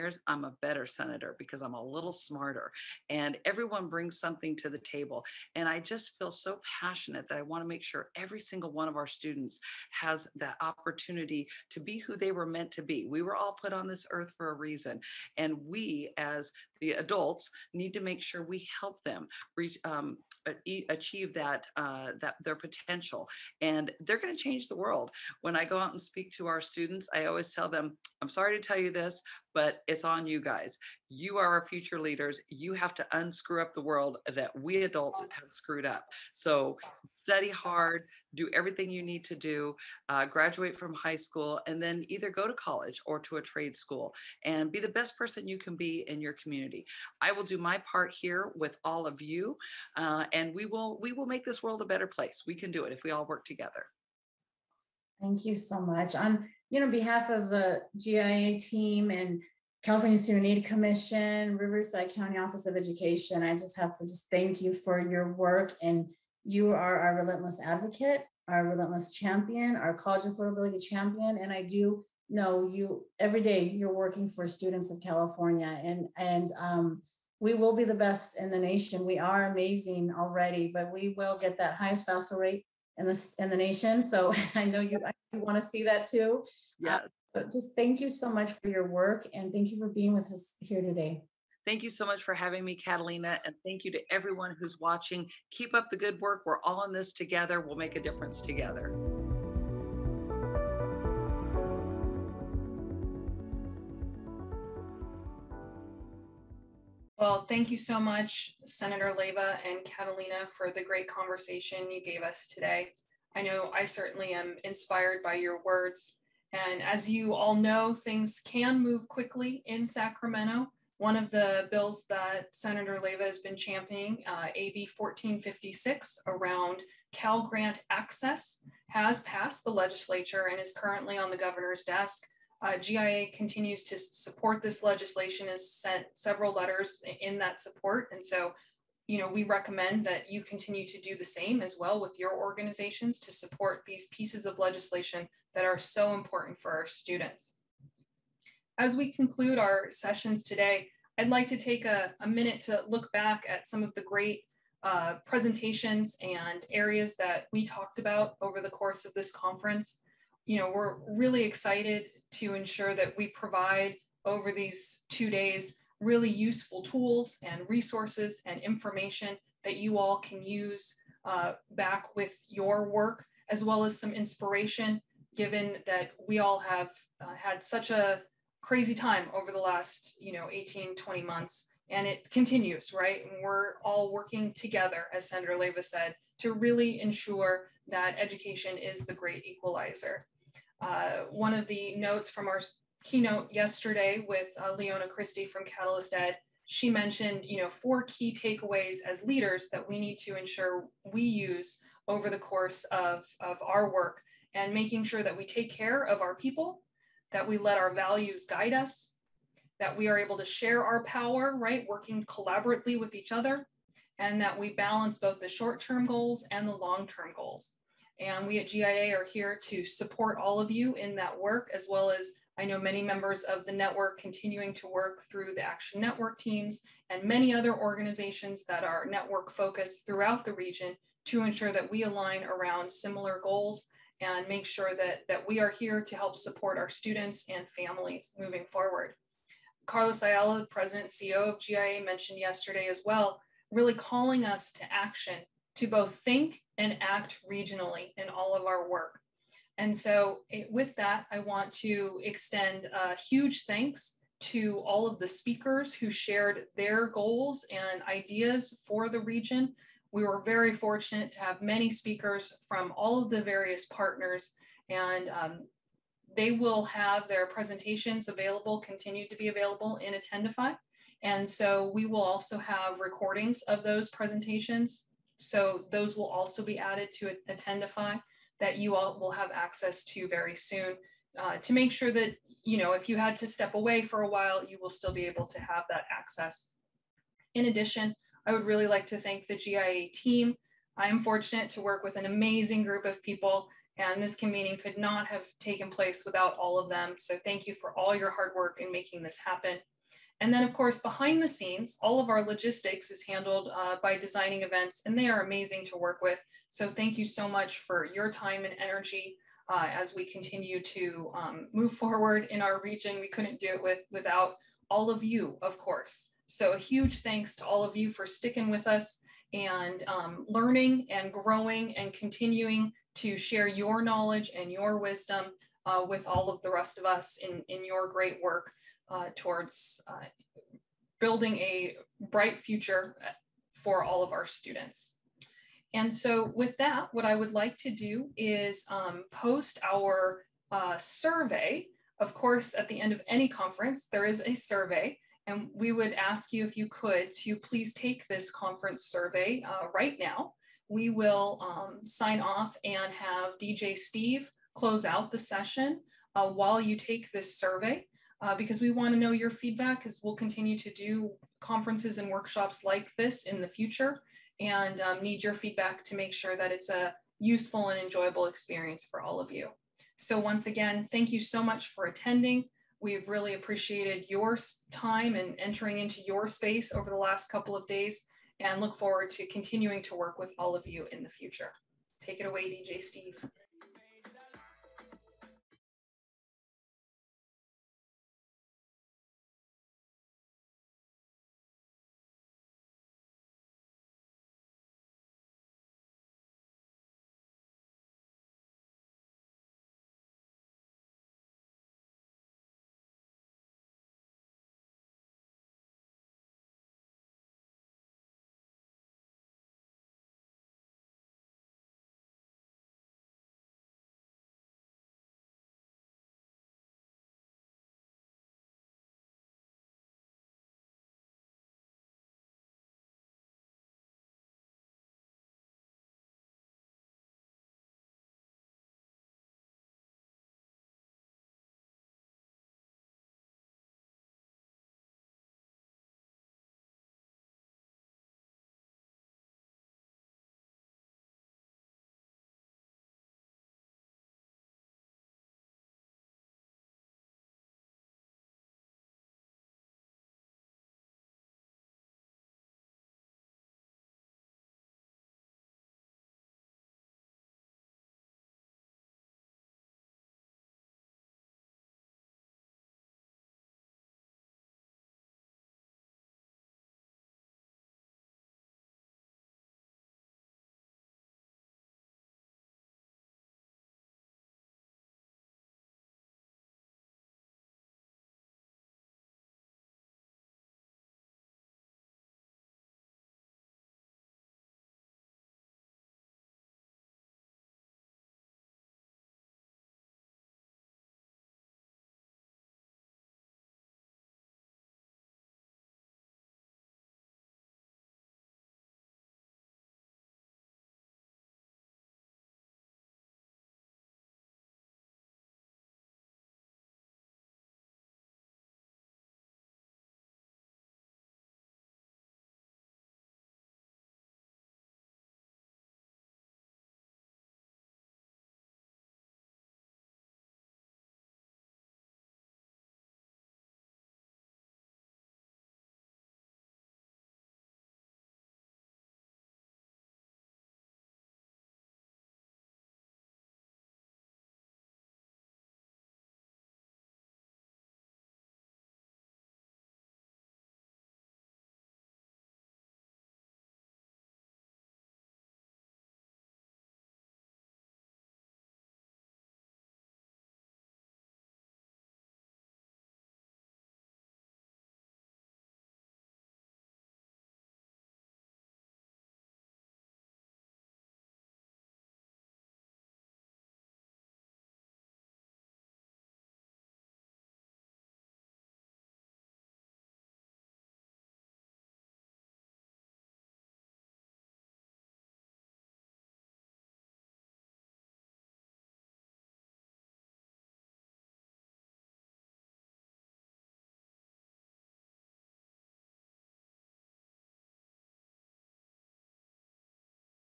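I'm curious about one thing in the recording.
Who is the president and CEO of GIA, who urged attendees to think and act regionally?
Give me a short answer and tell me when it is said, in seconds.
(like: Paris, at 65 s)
Carlos Ayala, at 239 s.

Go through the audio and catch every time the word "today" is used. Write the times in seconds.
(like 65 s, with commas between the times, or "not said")
90 s, 112 s, 150 s.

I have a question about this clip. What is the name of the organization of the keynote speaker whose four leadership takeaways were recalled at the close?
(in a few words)
Catalyst Ed.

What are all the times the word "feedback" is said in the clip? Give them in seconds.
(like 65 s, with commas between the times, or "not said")
359 s, 365 s.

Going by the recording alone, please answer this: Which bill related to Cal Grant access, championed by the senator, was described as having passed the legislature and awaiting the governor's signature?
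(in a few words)
AB 1456.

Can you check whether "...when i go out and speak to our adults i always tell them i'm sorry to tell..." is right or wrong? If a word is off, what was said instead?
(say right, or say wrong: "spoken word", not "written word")
wrong: "students", not "adults".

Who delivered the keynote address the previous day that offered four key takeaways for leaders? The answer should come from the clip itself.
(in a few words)
Leona Christie.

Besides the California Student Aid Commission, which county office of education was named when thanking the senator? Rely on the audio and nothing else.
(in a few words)
Riverside County.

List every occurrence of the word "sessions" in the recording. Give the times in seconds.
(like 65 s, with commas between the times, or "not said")
149 s, 355 s.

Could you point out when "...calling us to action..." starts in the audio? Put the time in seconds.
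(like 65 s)
243 s.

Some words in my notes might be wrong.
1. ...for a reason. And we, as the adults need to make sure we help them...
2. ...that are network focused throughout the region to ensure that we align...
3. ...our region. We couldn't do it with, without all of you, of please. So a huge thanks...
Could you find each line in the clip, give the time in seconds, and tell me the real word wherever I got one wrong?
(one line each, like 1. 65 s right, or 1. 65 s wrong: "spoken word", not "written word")
1. 14 s right
2. 228 s right
3. 312 s wrong: "course", not "please".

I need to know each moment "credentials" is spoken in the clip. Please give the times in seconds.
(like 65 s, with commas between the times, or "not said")
not said.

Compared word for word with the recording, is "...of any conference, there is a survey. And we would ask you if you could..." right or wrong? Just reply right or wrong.
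right.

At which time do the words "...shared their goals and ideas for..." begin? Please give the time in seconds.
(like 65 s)
256 s.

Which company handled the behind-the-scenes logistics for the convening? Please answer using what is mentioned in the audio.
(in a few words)
Designing Events.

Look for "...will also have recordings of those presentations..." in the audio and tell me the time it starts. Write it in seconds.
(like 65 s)
272 s.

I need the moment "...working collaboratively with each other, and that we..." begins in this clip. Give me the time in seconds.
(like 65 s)
211 s.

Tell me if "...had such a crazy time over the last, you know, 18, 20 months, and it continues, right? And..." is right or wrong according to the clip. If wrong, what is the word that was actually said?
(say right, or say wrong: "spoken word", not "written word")
right.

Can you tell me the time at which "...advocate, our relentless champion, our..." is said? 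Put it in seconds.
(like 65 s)
67 s.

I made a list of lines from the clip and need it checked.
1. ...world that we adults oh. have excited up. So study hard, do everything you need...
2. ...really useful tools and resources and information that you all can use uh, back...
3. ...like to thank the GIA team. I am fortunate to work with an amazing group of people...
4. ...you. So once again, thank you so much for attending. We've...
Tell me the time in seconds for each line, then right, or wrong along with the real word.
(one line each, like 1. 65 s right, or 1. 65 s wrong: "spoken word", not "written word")
1. 33 s wrong: "screwed", not "excited"
2. 165 s right
3. 288 s right
4. 369 s right.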